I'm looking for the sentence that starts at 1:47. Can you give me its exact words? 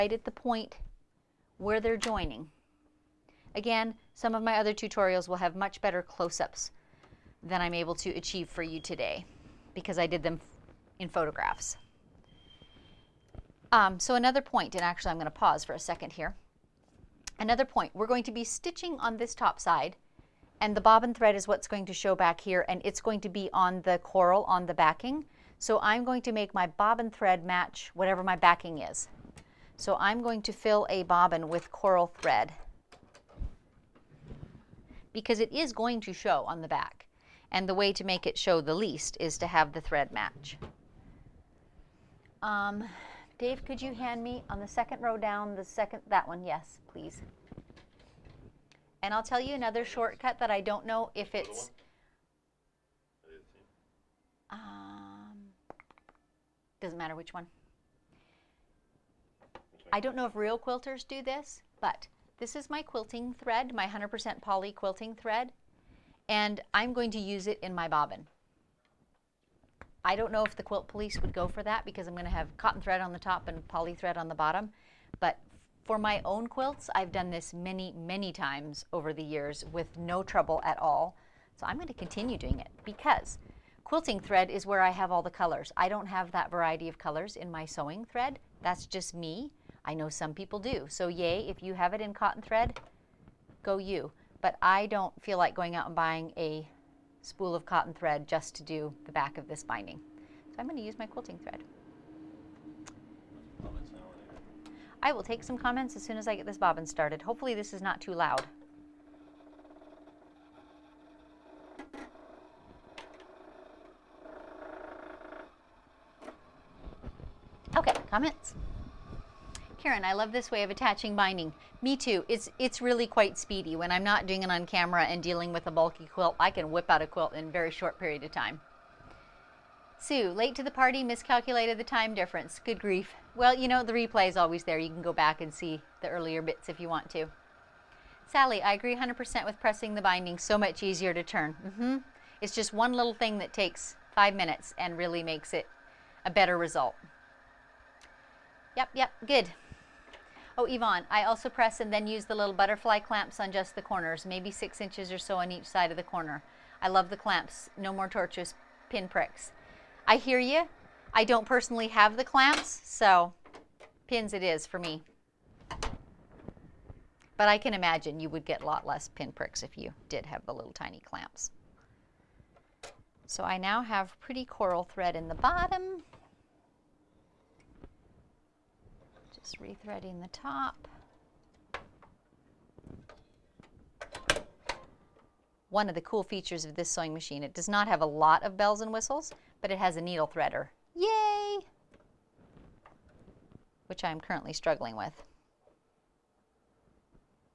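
Hopefully this is not too loud.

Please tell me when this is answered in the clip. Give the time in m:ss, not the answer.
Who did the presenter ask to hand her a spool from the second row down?
0:43.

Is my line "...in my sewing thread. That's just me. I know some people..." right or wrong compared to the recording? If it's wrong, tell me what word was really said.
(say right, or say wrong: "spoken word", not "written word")
right.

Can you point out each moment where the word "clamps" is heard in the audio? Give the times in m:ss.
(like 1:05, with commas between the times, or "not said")
2:32, 2:37, 2:42, 2:51.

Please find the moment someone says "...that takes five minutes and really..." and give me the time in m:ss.
2:23.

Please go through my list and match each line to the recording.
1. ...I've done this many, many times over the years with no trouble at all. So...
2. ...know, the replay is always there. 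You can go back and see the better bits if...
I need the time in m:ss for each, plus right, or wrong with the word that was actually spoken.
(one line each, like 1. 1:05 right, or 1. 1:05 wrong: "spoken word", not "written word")
1. 1:16 right
2. 2:13 wrong: "earlier", not "better".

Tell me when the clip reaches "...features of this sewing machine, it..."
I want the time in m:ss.
3:06.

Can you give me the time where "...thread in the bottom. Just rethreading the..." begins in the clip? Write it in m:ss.
2:54.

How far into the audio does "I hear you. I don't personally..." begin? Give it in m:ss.
2:40.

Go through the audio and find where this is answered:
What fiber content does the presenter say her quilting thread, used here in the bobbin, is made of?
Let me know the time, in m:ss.
1:03.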